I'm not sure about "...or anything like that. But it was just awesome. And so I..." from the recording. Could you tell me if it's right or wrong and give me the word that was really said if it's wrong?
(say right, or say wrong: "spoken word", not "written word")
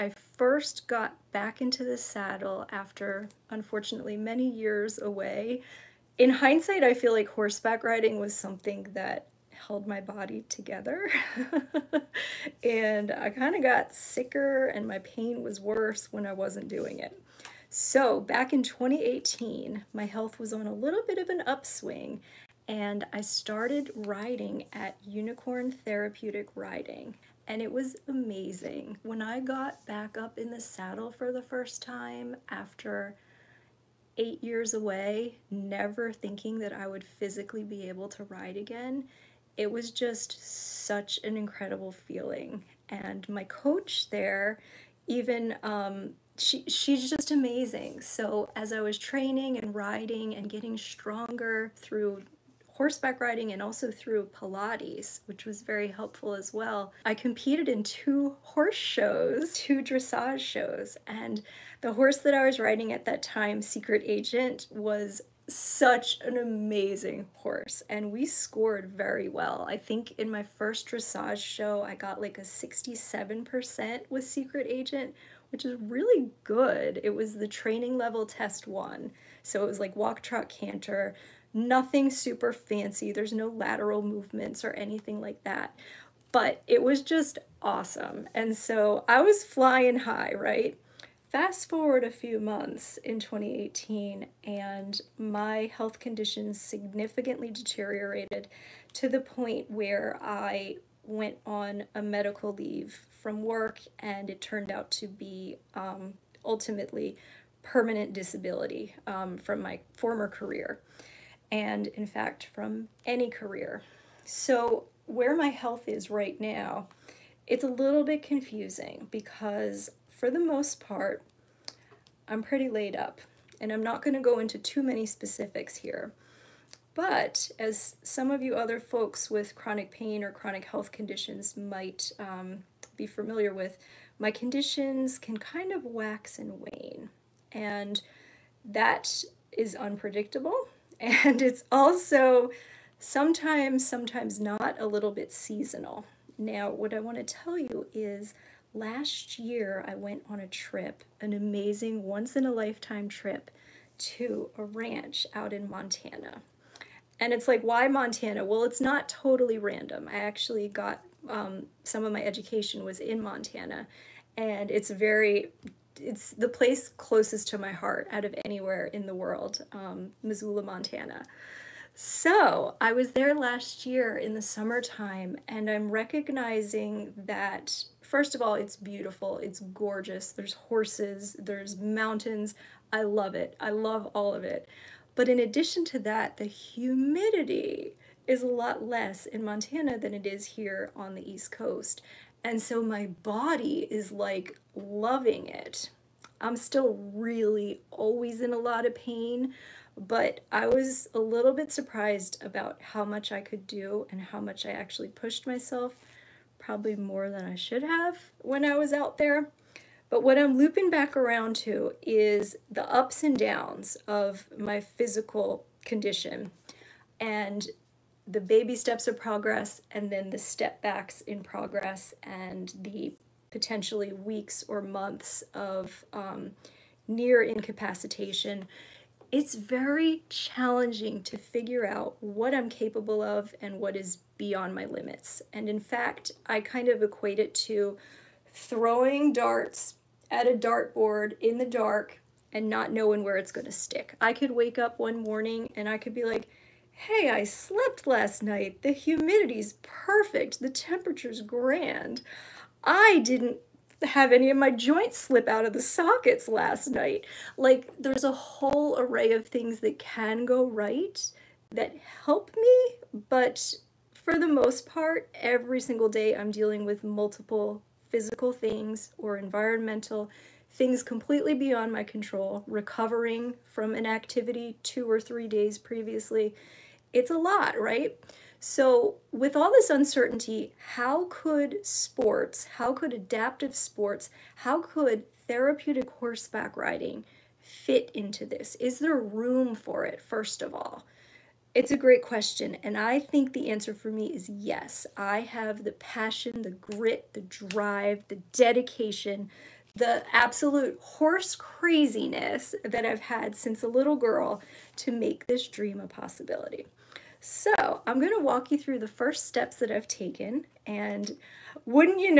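right.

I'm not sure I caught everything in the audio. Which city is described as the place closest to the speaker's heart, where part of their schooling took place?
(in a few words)
Missoula, Montana.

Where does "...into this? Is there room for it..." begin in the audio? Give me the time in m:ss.
4:48.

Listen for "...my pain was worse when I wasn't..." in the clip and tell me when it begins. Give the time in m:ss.
0:14.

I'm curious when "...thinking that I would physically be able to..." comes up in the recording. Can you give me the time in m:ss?
0:36.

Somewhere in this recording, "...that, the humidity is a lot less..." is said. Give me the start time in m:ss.
3:06.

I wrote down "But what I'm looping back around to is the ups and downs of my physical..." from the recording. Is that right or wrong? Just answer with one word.
right.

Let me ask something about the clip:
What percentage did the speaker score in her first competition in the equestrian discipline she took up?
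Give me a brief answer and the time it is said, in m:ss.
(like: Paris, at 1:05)
67%, at 1:12.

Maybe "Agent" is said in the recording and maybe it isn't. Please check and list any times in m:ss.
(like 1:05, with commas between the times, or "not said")
1:04, 1:14.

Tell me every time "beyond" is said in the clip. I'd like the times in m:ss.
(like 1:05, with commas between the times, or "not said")
3:54, 4:31.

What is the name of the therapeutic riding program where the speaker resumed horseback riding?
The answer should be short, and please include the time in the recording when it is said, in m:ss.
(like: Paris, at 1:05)
Unicorn Therapeutic Riding, at 0:25.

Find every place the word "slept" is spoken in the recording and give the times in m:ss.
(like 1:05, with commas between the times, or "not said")
4:07.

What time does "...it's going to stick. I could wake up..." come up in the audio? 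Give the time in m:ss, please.
4:03.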